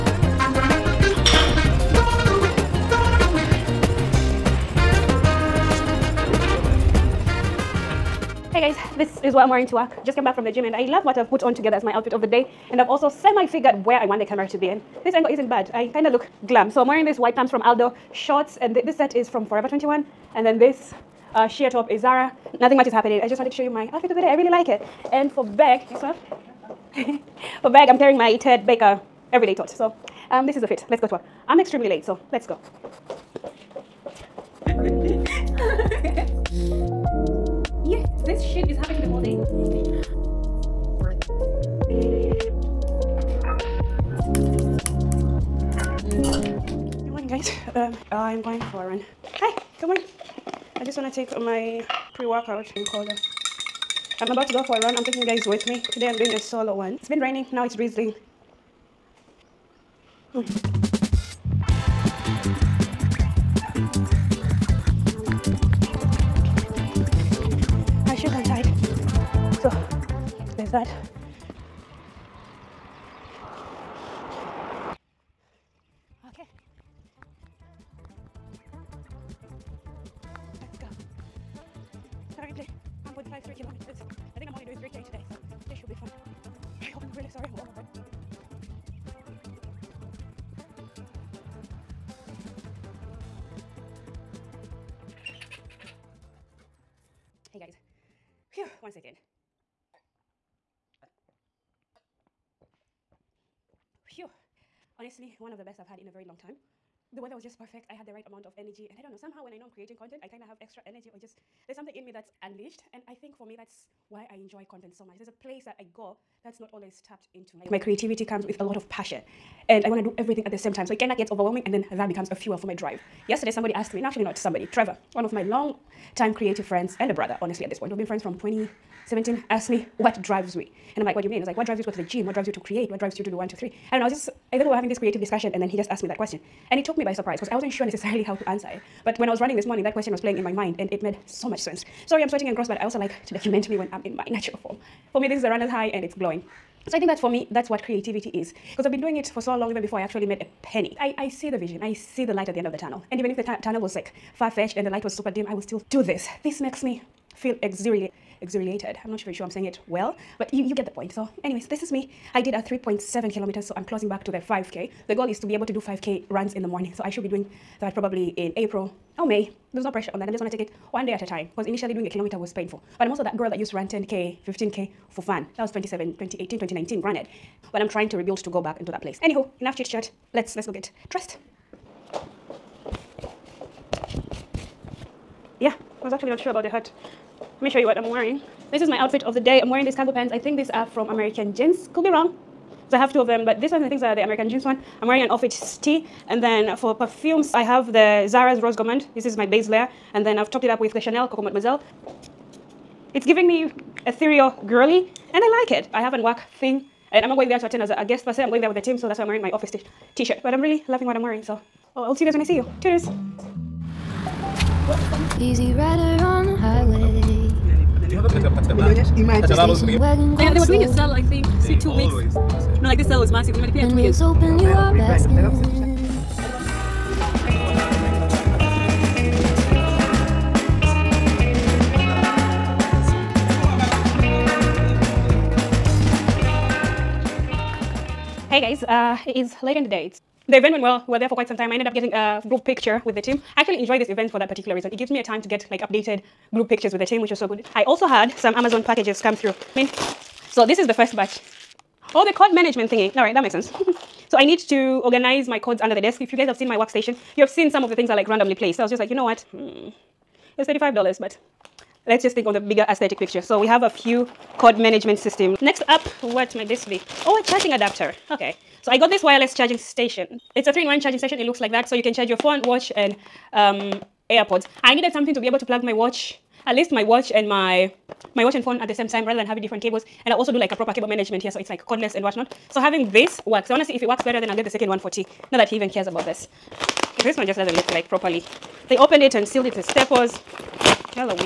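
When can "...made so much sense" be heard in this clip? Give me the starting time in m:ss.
2:21.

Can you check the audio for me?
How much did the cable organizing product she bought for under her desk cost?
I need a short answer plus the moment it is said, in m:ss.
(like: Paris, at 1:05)
$35, at 4:20.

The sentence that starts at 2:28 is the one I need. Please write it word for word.
Because I've been doing it for so long, even before I actually made a penny.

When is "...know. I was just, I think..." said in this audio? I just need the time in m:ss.
2:14.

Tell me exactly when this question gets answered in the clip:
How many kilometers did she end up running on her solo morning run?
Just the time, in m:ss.
2:42.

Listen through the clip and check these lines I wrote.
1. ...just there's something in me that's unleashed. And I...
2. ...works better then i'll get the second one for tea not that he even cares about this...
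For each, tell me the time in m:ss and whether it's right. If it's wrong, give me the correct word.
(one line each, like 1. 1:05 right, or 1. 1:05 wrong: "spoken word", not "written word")
1. 1:51 right
2. 4:44 right.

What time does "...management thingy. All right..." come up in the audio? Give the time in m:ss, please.
4:12.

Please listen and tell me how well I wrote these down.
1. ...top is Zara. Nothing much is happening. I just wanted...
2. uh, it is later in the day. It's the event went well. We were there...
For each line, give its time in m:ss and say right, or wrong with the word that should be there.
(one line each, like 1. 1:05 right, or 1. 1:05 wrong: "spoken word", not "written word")
1. 0:21 right
2. 3:58 right.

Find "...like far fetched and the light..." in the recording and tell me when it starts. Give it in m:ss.
2:33.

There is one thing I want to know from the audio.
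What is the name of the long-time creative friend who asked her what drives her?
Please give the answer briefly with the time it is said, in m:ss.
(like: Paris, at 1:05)
Trevor, at 2:04.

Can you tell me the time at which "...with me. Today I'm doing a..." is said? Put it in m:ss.
0:55.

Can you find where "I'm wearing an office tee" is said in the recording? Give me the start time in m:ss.
3:15.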